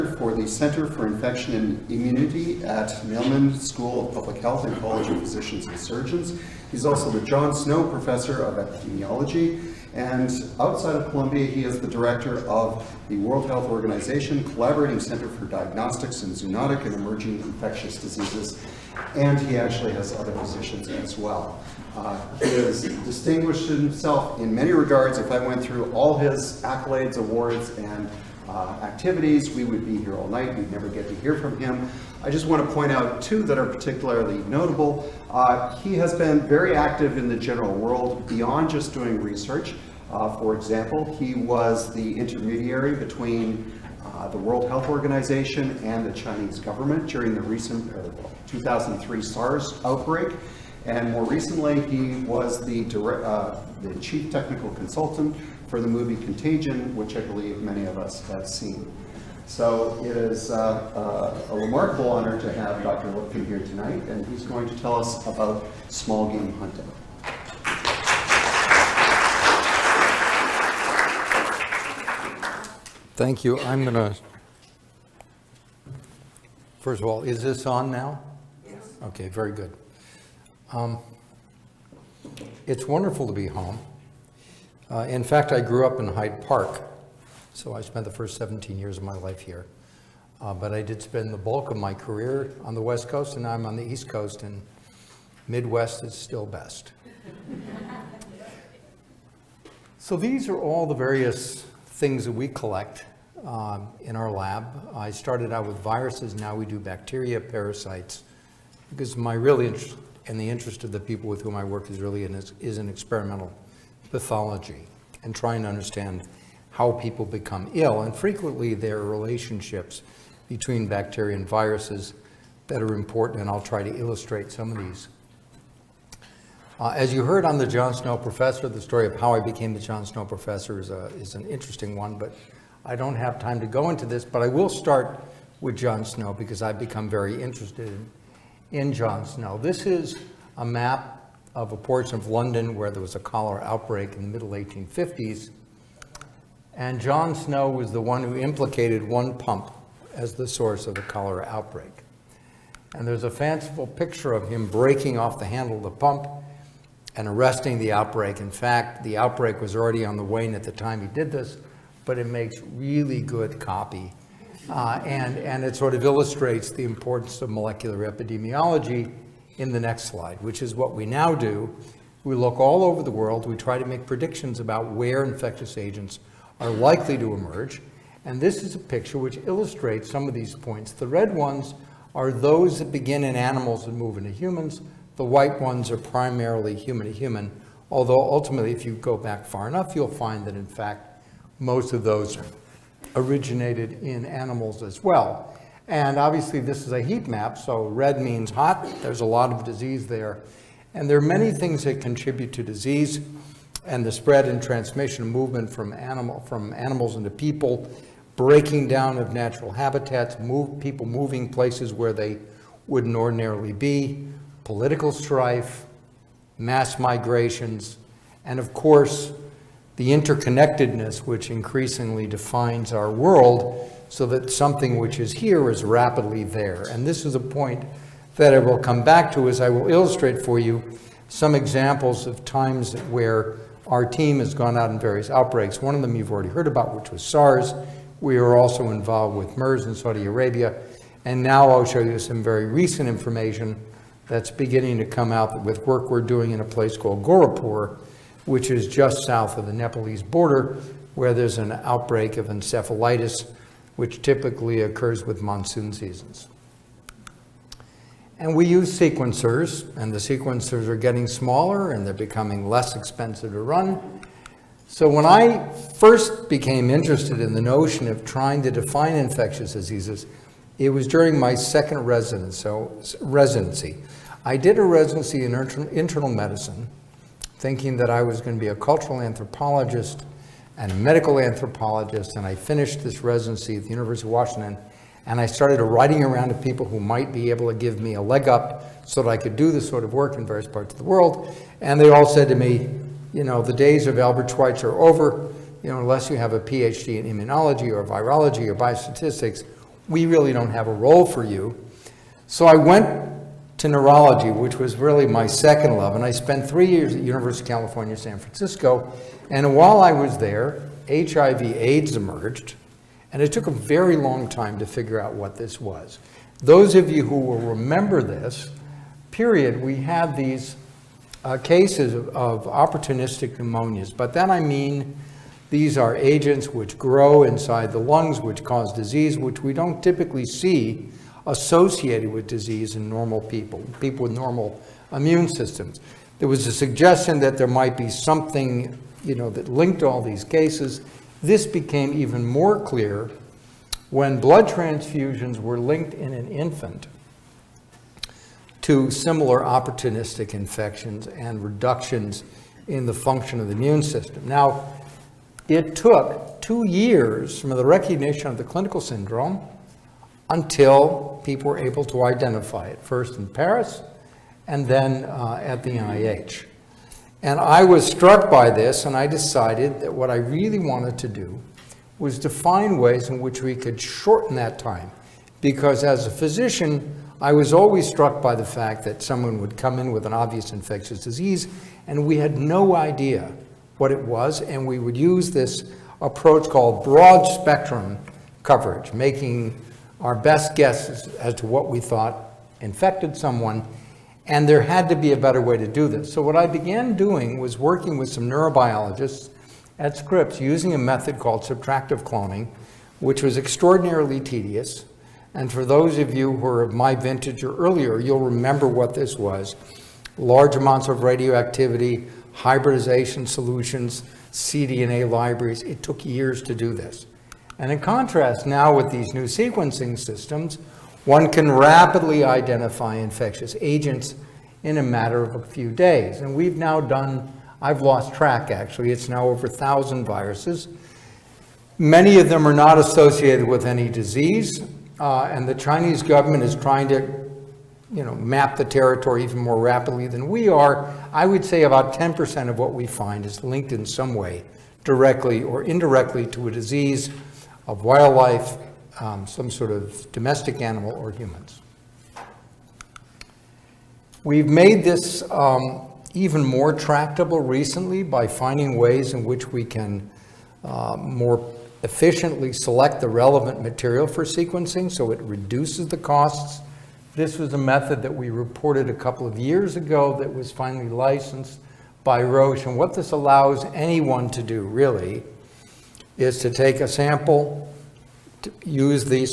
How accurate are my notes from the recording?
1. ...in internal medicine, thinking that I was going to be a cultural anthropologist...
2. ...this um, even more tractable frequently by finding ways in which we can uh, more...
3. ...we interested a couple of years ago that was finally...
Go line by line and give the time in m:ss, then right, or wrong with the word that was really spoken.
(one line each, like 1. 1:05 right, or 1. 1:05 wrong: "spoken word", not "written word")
1. 4:35 right
2. 7:35 wrong: "recently", not "frequently"
3. 7:48 wrong: "reported", not "interested".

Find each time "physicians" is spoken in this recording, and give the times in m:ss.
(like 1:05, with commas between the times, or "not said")
0:05, 6:16.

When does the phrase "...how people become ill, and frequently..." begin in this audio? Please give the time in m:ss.
1:56.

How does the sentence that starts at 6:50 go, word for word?
Large amounts of radioactivity, hybridization solutions, cDNA libraries.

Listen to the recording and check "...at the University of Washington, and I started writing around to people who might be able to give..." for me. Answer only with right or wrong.
right.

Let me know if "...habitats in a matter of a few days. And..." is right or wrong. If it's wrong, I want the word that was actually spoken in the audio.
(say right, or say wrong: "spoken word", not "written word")
wrong: "agents", not "habitats".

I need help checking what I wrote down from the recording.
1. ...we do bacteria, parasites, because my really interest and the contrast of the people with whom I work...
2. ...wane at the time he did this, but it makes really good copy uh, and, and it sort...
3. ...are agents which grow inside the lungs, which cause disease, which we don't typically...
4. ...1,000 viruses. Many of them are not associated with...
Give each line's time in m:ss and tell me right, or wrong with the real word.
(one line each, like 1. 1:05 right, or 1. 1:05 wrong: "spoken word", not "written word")
1. 1:46 wrong: "interest", not "contrast"
2. 2:40 right
3. 5:25 right
4. 7:09 right.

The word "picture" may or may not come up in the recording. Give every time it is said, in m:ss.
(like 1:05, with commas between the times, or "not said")
2:33, 2:58.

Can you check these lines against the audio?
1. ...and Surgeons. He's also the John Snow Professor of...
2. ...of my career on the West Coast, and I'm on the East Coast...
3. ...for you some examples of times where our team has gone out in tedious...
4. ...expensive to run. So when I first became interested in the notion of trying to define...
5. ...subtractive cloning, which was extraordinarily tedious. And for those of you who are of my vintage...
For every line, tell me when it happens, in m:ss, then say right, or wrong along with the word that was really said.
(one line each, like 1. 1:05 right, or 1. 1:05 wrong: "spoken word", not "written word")
1. 0:05 right
2. 1:31 right
3. 3:50 wrong: "various", not "tedious"
4. 4:22 right
5. 6:41 right.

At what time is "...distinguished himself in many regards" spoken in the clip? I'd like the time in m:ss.
0:23.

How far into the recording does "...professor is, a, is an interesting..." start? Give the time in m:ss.
2:10.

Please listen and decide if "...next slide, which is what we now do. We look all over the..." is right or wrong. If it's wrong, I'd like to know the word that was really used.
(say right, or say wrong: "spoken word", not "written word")
right.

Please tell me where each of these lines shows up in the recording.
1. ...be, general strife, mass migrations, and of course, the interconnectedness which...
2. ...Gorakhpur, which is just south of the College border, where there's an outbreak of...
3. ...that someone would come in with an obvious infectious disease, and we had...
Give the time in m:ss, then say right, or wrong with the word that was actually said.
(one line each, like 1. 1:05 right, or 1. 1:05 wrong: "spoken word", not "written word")
1. 3:33 wrong: "political", not "general"
2. 4:07 wrong: "Nepalese", not "College"
3. 6:19 right.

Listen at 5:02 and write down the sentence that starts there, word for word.
So I went to neurology, which was really my second love.